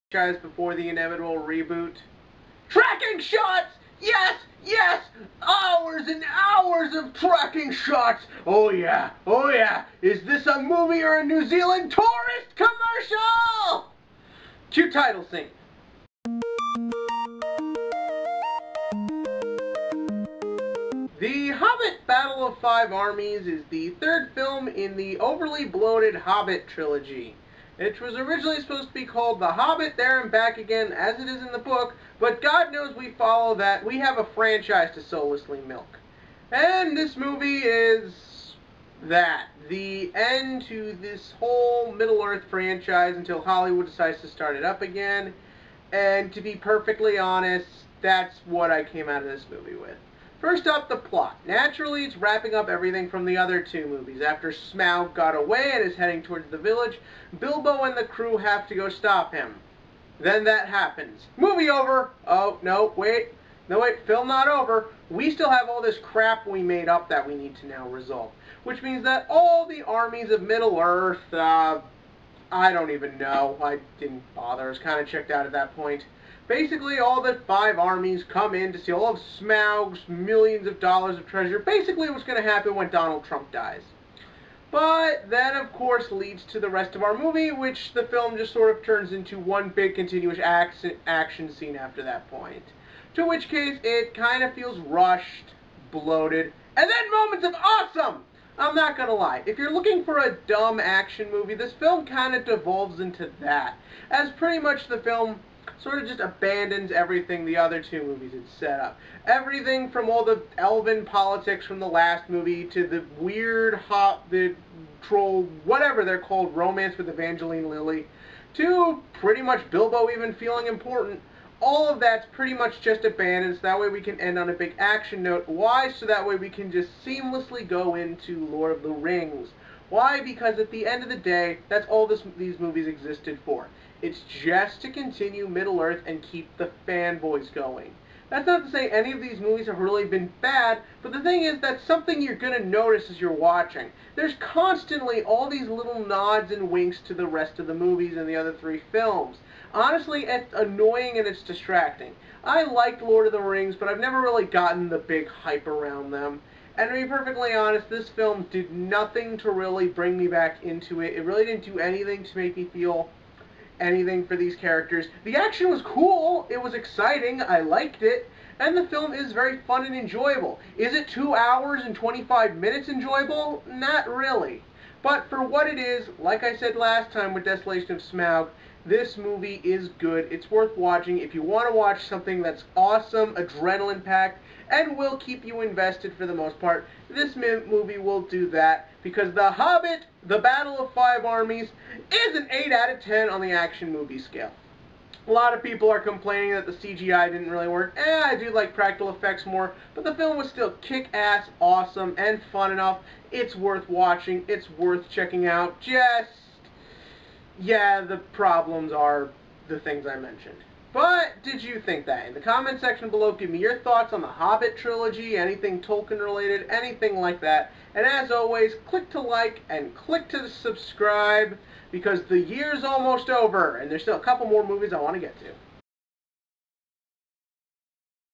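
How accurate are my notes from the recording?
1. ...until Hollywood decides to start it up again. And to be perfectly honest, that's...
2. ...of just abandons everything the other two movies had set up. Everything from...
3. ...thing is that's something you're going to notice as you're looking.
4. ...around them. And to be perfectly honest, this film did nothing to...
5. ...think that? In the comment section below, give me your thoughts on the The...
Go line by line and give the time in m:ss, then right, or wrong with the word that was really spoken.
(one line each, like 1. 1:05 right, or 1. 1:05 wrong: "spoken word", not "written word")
1. 0:43 right
2. 1:46 right
3. 2:21 wrong: "watching", not "looking"
4. 2:35 right
5. 3:31 wrong: "Hobbit", not "The".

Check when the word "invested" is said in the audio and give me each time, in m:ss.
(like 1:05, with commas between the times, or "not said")
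3:05.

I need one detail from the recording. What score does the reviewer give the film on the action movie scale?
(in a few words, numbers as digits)
8 out of 10.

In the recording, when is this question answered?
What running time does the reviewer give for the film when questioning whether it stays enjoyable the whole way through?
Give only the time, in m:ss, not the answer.
2:51.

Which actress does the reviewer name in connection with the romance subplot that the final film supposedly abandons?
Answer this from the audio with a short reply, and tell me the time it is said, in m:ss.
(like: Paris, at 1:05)
Evangeline Lilly, at 1:57.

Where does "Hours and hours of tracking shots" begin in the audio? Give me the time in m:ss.
0:05.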